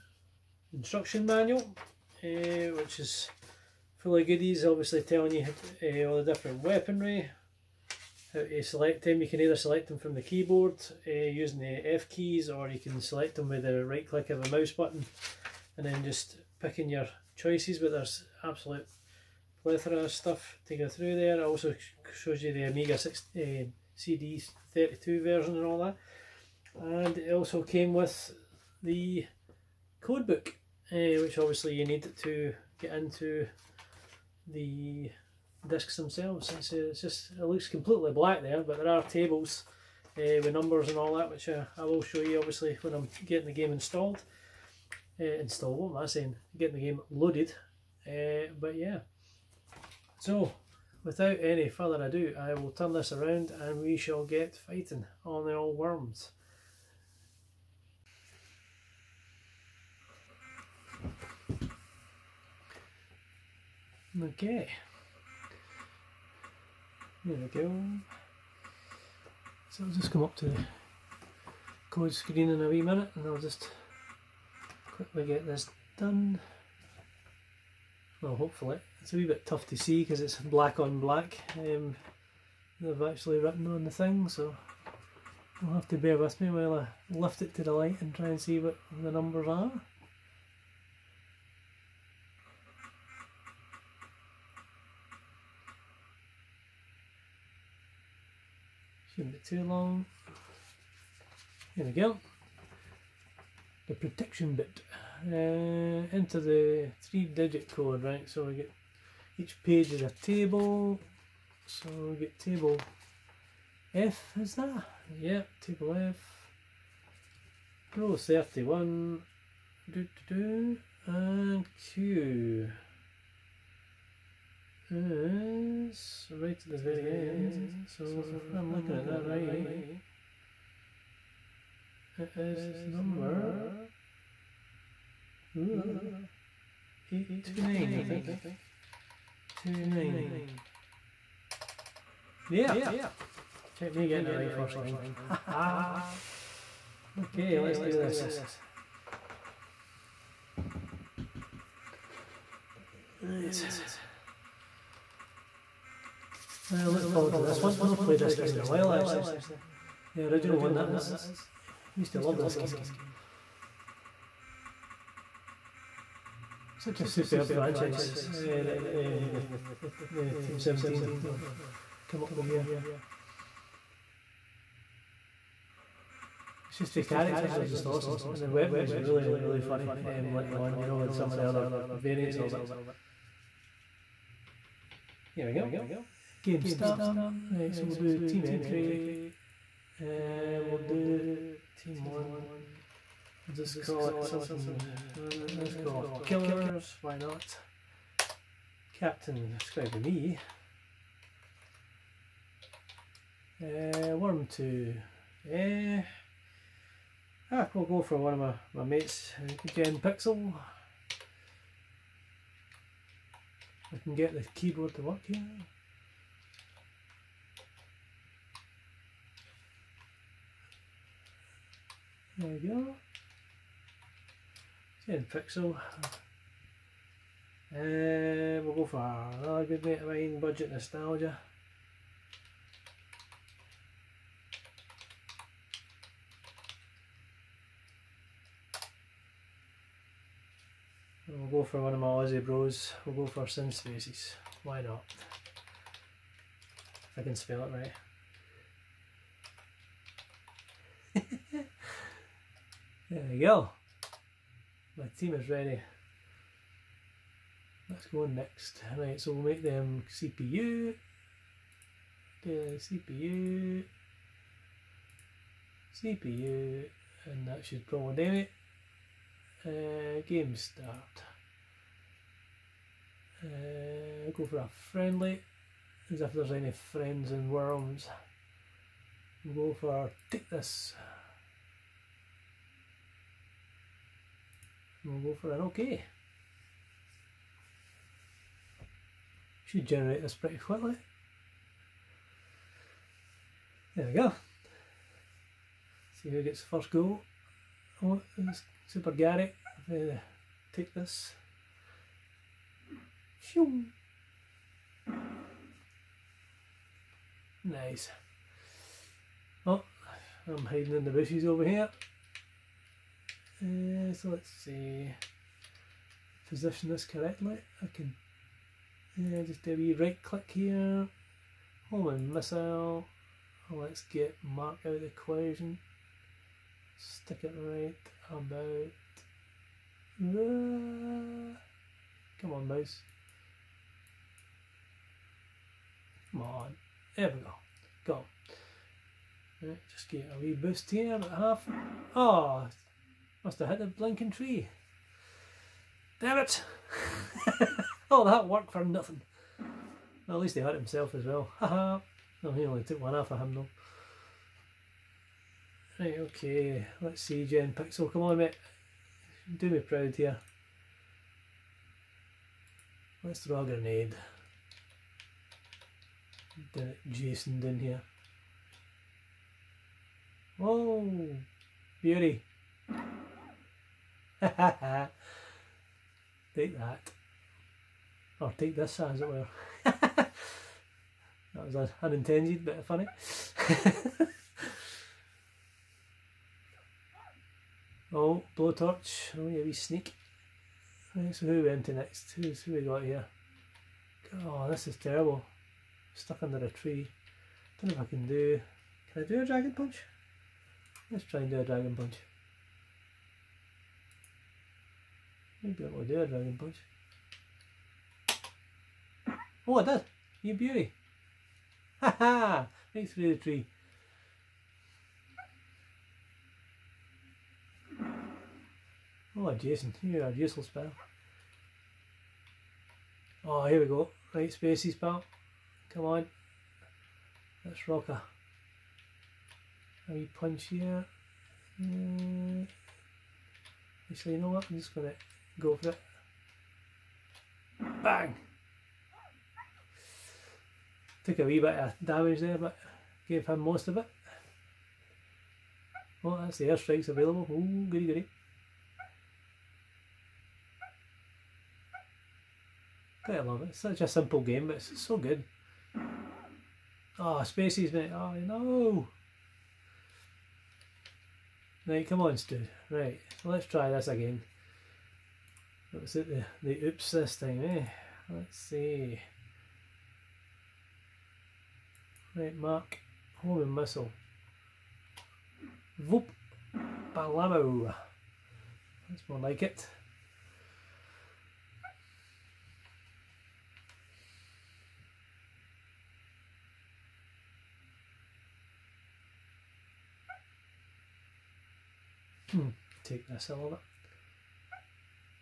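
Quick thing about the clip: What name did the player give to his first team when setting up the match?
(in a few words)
killers.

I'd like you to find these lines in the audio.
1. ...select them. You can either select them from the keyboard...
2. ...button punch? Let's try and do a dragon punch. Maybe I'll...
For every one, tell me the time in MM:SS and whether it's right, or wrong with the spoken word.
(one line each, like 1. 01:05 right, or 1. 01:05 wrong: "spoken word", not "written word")
1. 00:08 right
2. 06:39 wrong: "dragon", not "button".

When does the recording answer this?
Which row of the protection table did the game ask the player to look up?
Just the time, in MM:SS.
01:57.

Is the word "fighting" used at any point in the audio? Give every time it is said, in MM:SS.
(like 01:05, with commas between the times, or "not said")
00:54.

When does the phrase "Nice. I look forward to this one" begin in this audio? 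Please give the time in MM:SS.
02:33.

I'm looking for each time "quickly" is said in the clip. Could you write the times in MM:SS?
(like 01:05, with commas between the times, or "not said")
01:14, 04:50.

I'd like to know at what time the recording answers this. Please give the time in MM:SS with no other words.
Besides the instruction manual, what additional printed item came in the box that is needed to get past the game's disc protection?
00:30.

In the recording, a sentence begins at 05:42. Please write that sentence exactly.
Oh, must have hit the blinking tree.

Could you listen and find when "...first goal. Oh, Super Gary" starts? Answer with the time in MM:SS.
04:56.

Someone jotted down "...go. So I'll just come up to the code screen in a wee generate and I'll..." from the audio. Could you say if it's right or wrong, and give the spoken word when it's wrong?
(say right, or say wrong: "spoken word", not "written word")
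wrong: "minute", not "generate".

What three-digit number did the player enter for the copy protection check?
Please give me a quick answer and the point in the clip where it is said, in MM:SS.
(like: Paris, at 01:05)
829, at 02:17.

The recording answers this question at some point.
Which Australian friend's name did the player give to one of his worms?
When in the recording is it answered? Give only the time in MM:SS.
04:03.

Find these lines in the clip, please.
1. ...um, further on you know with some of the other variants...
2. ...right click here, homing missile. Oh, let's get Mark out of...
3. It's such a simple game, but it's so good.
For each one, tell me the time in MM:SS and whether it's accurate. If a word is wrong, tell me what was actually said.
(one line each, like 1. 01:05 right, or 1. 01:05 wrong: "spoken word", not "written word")
1. 03:00 wrong: "later", not "further"
2. 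05:19 right
3. 07:33 right.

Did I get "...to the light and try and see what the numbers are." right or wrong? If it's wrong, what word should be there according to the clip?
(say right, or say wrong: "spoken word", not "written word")
right.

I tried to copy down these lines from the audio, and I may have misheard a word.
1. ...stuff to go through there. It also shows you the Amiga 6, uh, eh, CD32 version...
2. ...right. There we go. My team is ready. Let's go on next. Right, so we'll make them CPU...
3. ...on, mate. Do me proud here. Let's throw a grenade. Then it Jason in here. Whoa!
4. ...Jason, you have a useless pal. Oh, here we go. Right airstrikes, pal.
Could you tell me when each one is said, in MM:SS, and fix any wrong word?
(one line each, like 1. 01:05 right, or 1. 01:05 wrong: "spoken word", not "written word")
1. 00:20 right
2. 04:07 right
3. 05:58 right
4. 06:59 wrong: "spaces", not "airstrikes".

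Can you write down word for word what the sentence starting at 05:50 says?
Well, at least he hurt himself as well.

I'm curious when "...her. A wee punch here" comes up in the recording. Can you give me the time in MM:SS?
07:08.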